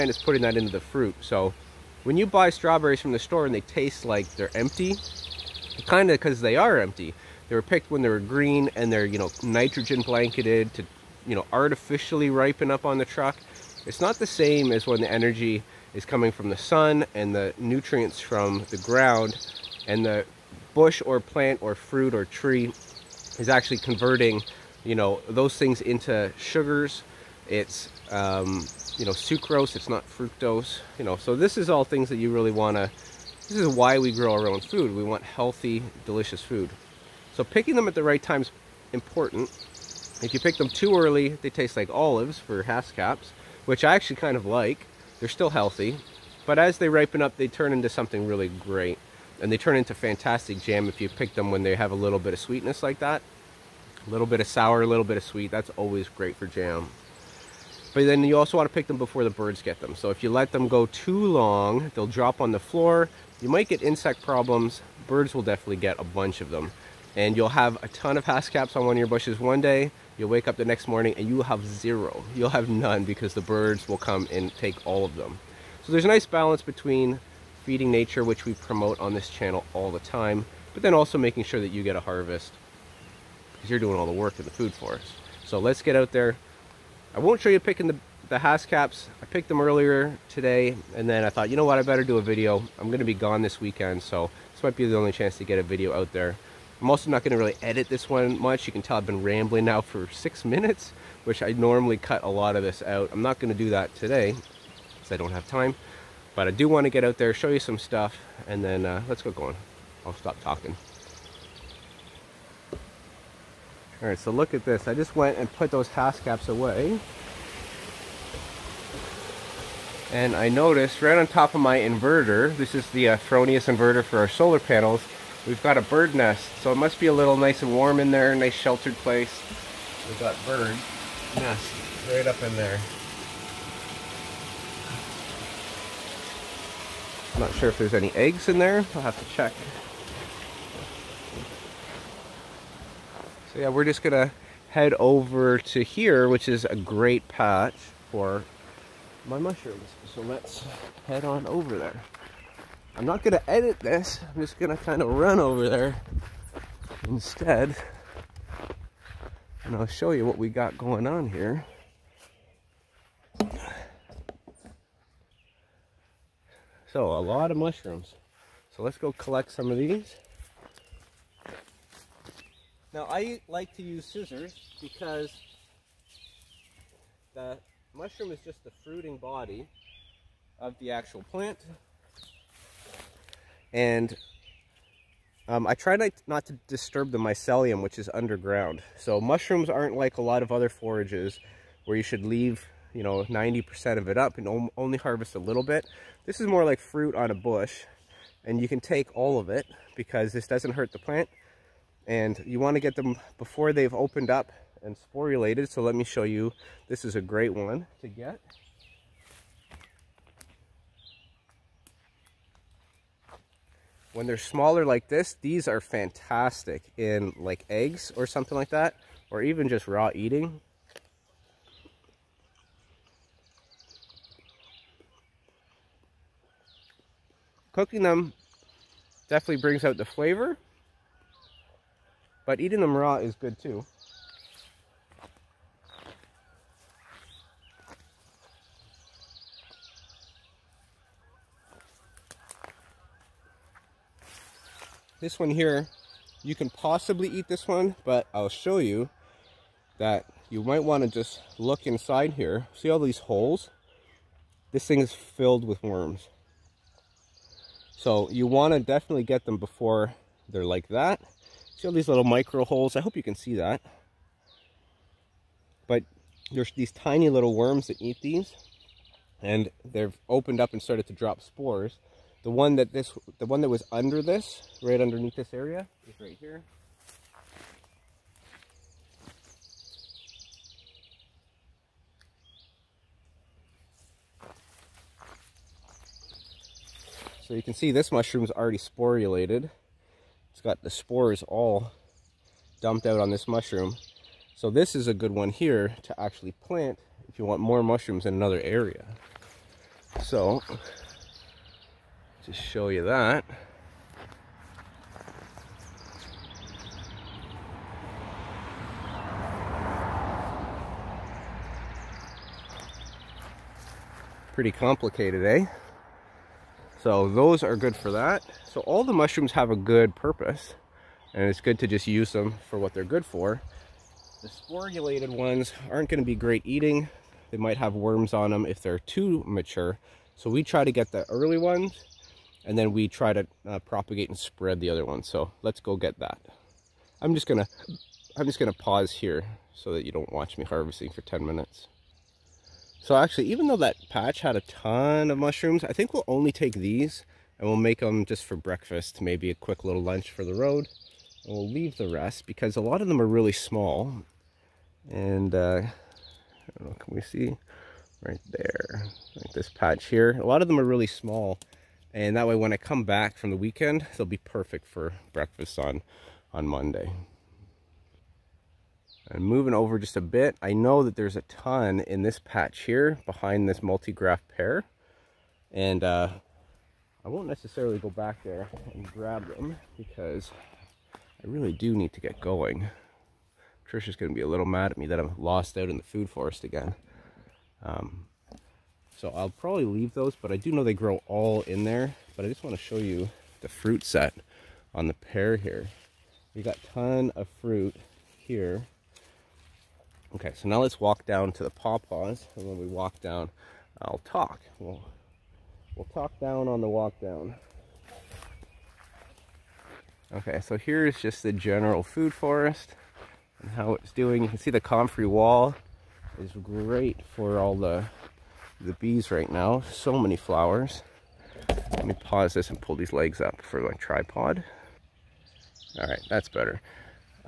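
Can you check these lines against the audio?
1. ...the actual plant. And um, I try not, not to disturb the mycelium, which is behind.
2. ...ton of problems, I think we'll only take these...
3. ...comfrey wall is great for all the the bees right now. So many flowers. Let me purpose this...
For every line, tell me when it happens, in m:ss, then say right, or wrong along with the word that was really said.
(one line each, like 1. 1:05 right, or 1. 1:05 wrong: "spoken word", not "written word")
1. 3:00 wrong: "underground", not "behind"
2. 5:44 wrong: "mushrooms", not "problems"
3. 6:54 wrong: "pause", not "purpose".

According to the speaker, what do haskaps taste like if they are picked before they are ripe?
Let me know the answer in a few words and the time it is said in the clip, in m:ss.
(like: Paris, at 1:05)
Olives, at 0:41.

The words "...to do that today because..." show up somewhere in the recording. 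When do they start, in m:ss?
1:43.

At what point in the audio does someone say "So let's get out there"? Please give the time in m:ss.
1:25.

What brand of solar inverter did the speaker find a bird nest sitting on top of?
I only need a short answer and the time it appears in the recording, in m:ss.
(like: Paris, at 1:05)
Fronius, at 2:03.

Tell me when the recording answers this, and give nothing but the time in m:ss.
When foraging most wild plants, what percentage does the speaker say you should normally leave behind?
3:13.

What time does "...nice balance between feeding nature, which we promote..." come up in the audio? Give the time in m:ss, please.
1:16.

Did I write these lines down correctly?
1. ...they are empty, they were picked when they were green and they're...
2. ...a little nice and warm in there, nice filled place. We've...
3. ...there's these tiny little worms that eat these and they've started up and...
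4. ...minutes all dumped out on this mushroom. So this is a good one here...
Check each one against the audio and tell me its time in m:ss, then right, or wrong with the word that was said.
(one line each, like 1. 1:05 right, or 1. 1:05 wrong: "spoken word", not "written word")
1. 0:06 right
2. 2:07 wrong: "sheltered", not "filled"
3. 4:26 wrong: "opened", not "started"
4. 4:50 wrong: "spores", not "minutes".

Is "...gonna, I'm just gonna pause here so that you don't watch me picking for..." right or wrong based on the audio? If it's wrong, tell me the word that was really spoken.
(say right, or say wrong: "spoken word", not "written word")
wrong: "harvesting", not "picking".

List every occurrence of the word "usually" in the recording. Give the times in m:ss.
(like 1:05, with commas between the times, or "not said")
not said.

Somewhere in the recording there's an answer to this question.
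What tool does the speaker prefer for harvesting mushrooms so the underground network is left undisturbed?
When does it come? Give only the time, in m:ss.
2:54.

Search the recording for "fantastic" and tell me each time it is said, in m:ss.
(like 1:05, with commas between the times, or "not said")
0:49, 3:35.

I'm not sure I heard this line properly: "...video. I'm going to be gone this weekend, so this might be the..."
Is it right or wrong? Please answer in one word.
right.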